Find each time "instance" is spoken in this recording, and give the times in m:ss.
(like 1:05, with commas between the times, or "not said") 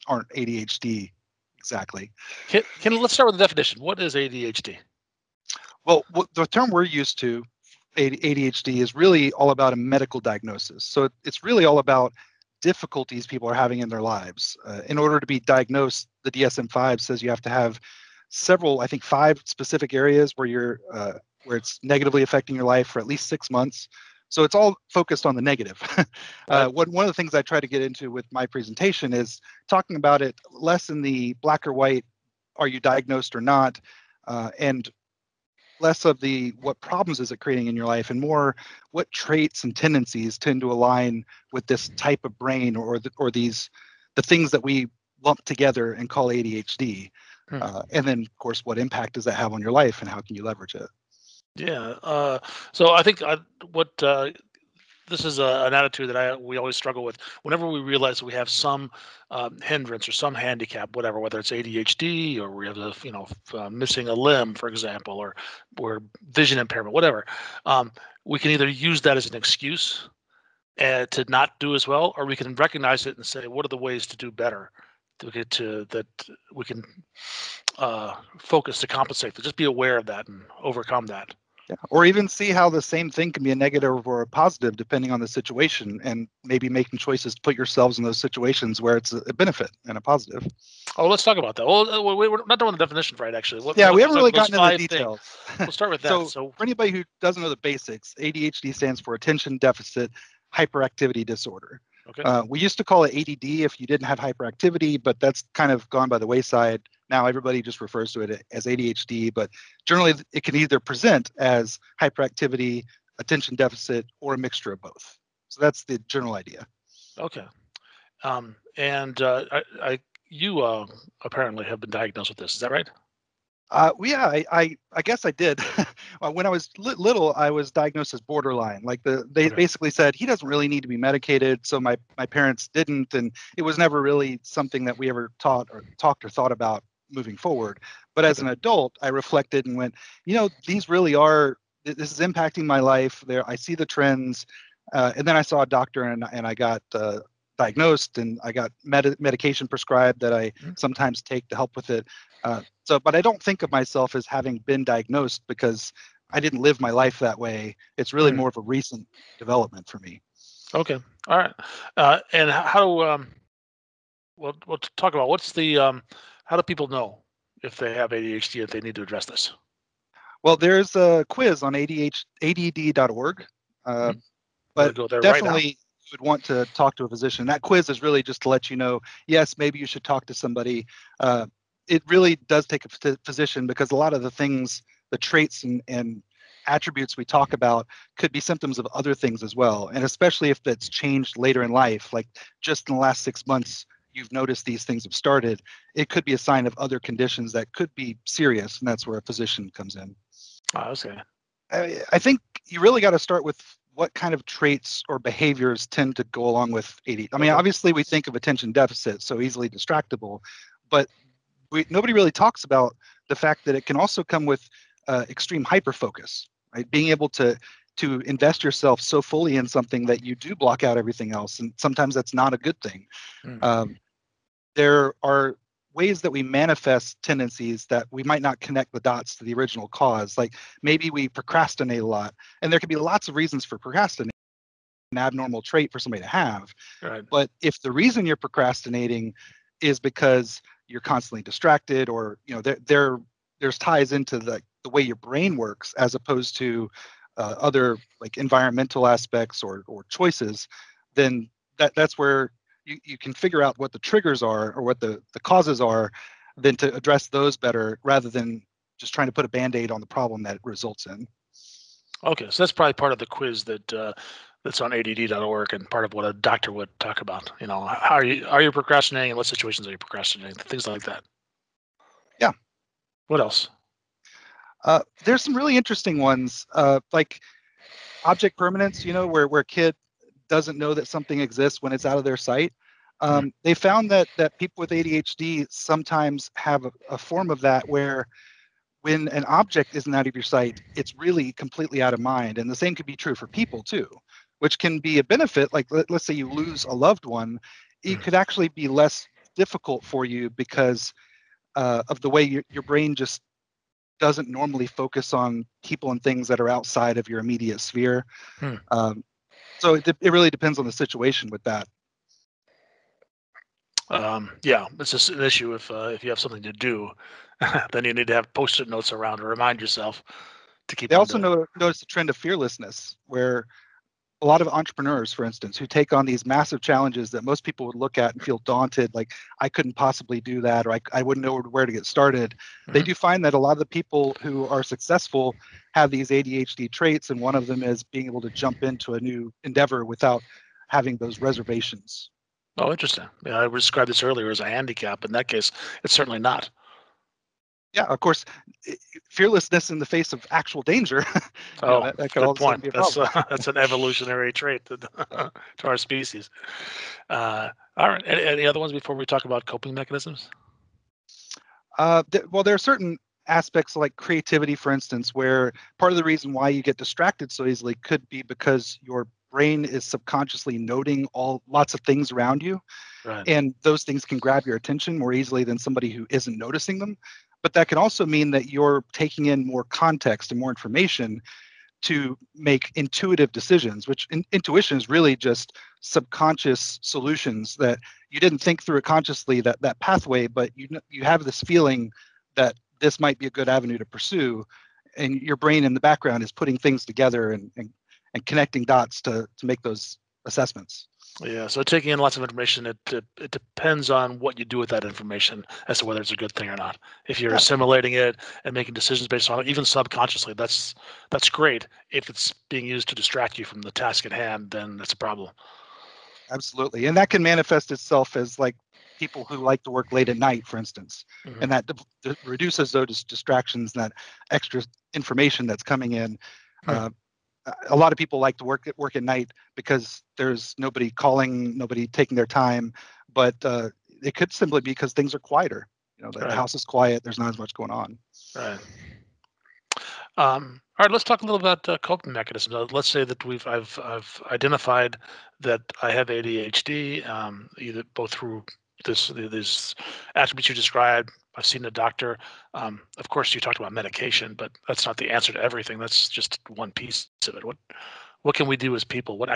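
5:25, 6:04, 7:00.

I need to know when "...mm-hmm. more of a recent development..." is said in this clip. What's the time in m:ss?
2:38.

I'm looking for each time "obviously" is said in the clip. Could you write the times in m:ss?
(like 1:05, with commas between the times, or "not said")
3:27.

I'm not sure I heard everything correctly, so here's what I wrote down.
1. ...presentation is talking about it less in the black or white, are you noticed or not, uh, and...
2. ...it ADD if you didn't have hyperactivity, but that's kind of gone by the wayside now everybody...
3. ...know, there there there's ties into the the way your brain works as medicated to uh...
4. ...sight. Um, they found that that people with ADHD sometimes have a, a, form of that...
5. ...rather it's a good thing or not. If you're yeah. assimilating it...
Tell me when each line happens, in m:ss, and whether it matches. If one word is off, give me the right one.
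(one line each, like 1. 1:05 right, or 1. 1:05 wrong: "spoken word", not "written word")
1. 0:28 wrong: "diagnosed", not "noticed"
2. 1:43 right
3. 4:02 wrong: "opposed", not "medicated"
4. 4:42 right
5. 6:46 wrong: "whether", not "rather".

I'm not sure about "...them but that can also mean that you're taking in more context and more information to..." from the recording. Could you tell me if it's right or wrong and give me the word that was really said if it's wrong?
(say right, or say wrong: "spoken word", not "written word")
right.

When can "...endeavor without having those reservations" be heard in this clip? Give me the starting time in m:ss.
5:39.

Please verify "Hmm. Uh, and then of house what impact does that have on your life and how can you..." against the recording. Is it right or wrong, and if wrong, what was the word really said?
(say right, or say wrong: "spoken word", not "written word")
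wrong: "course", not "house".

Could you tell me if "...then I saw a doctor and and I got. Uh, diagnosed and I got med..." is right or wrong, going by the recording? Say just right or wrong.
right.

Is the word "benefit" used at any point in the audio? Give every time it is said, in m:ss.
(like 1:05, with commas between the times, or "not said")
1:29, 4:55.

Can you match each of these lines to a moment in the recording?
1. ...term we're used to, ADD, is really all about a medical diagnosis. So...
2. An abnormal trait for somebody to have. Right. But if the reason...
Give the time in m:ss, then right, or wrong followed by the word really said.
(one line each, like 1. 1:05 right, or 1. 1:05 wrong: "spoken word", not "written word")
1. 0:06 wrong: "ADHD", not "ADD"
2. 3:55 right.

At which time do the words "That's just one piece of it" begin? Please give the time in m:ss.
7:35.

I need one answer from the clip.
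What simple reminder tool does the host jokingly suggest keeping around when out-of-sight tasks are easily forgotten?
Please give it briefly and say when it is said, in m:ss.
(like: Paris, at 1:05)
Post-it notes, at 5:18.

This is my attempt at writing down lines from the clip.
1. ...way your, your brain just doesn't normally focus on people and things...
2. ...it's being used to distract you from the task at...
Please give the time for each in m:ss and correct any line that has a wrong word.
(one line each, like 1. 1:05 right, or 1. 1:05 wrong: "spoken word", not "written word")
1. 5:02 right
2. 6:52 right.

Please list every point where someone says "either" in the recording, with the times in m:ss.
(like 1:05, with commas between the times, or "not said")
1:08, 1:50, 7:27.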